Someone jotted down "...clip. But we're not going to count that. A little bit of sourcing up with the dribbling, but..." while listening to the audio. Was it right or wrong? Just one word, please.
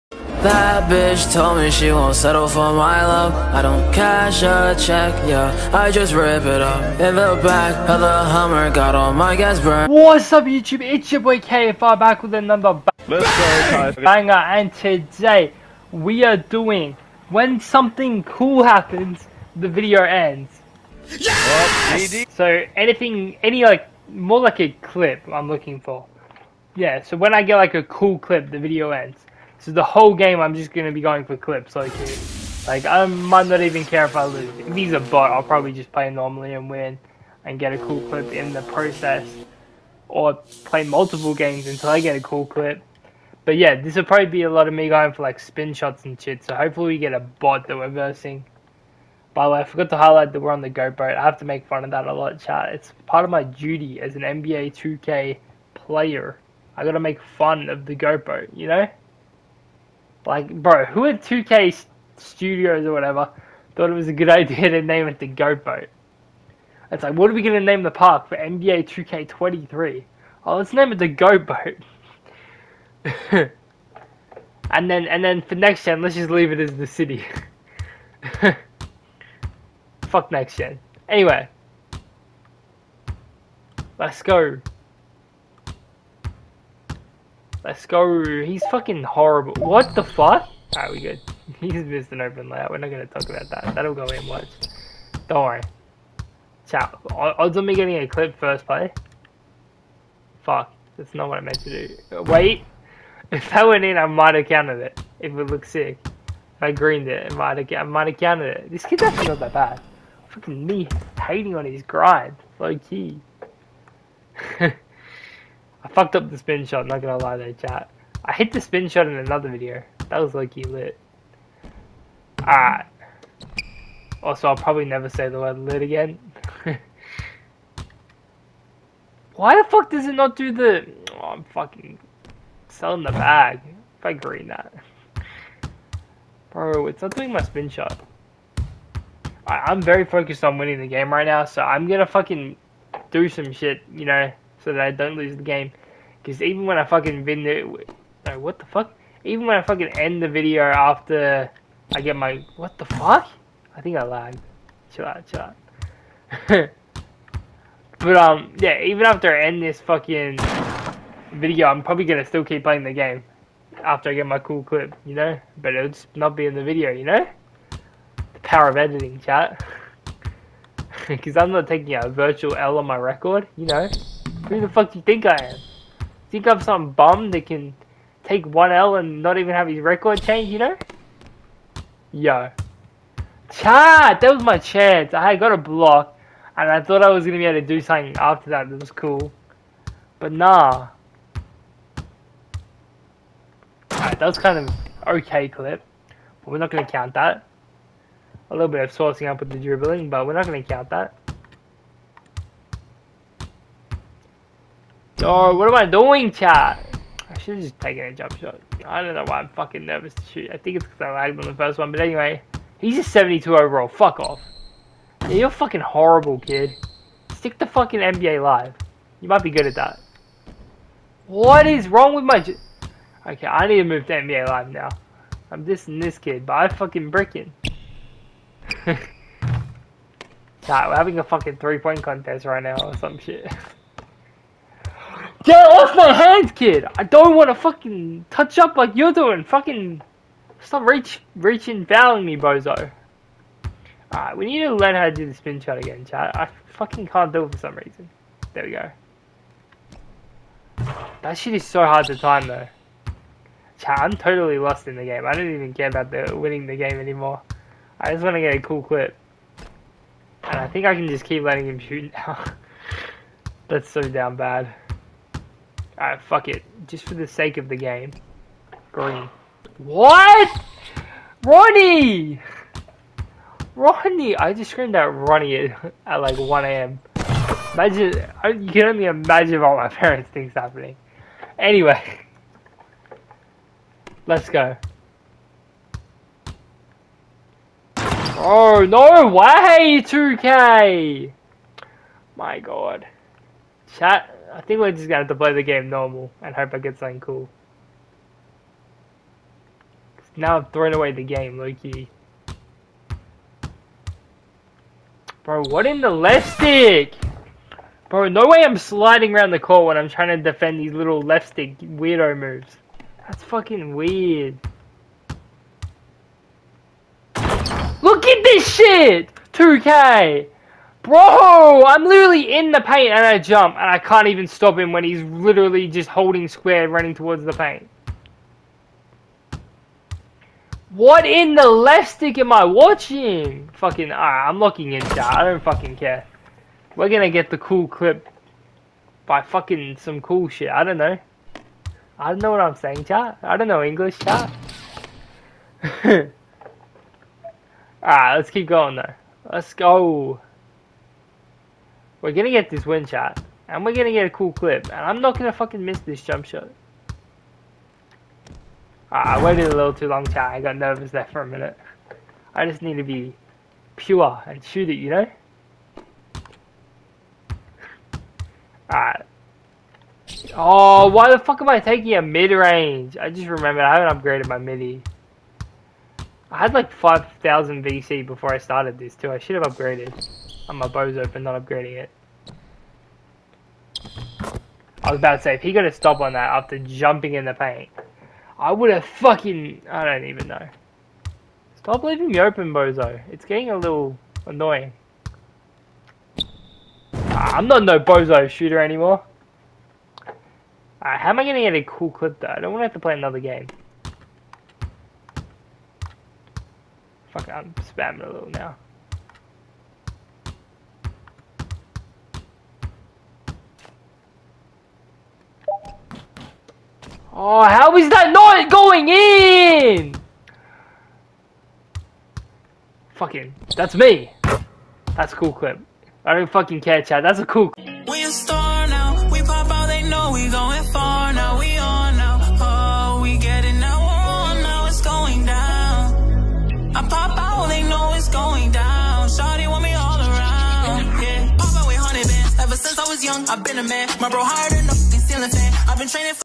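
right.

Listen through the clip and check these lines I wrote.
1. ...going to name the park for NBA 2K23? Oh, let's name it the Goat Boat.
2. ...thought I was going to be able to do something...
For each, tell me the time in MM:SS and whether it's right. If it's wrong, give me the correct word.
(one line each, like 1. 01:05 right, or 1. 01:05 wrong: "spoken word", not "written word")
1. 01:07 right
2. 03:06 right.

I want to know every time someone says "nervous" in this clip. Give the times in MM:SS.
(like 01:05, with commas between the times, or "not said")
03:29, 06:00.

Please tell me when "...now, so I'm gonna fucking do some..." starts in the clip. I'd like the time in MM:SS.
02:21.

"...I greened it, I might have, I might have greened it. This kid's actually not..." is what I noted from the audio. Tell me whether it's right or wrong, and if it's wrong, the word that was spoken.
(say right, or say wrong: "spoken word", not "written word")
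wrong: "counted", not "greened".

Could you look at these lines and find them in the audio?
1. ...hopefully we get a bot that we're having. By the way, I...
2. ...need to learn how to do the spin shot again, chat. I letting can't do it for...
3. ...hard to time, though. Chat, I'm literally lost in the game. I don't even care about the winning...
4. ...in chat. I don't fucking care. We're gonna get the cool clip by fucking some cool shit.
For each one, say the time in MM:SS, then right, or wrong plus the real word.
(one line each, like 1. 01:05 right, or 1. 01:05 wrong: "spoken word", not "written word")
1. 00:46 wrong: "versing", not "having"
2. 04:04 wrong: "fucking", not "letting"
3. 04:11 wrong: "totally", not "literally"
4. 05:34 right.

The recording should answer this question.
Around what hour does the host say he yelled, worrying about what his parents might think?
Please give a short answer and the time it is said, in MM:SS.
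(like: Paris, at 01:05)
1 a.m., at 04:36.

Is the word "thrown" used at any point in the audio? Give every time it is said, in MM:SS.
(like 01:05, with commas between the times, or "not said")
05:00.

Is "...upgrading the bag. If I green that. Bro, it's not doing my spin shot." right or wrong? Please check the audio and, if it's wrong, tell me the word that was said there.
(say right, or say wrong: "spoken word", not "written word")
wrong: "selling", not "upgrading".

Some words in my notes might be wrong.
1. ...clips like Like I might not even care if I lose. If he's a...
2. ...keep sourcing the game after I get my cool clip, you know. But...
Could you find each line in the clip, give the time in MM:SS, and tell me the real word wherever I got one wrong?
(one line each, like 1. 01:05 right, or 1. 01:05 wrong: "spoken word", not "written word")
1. 00:31 right
2. 02:42 wrong: "playing", not "sourcing".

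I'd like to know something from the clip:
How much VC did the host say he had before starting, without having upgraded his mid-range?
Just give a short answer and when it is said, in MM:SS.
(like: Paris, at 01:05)
5,000, at 06:16.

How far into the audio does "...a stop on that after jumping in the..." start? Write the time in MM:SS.
06:25.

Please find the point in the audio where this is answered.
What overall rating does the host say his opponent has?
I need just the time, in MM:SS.
03:33.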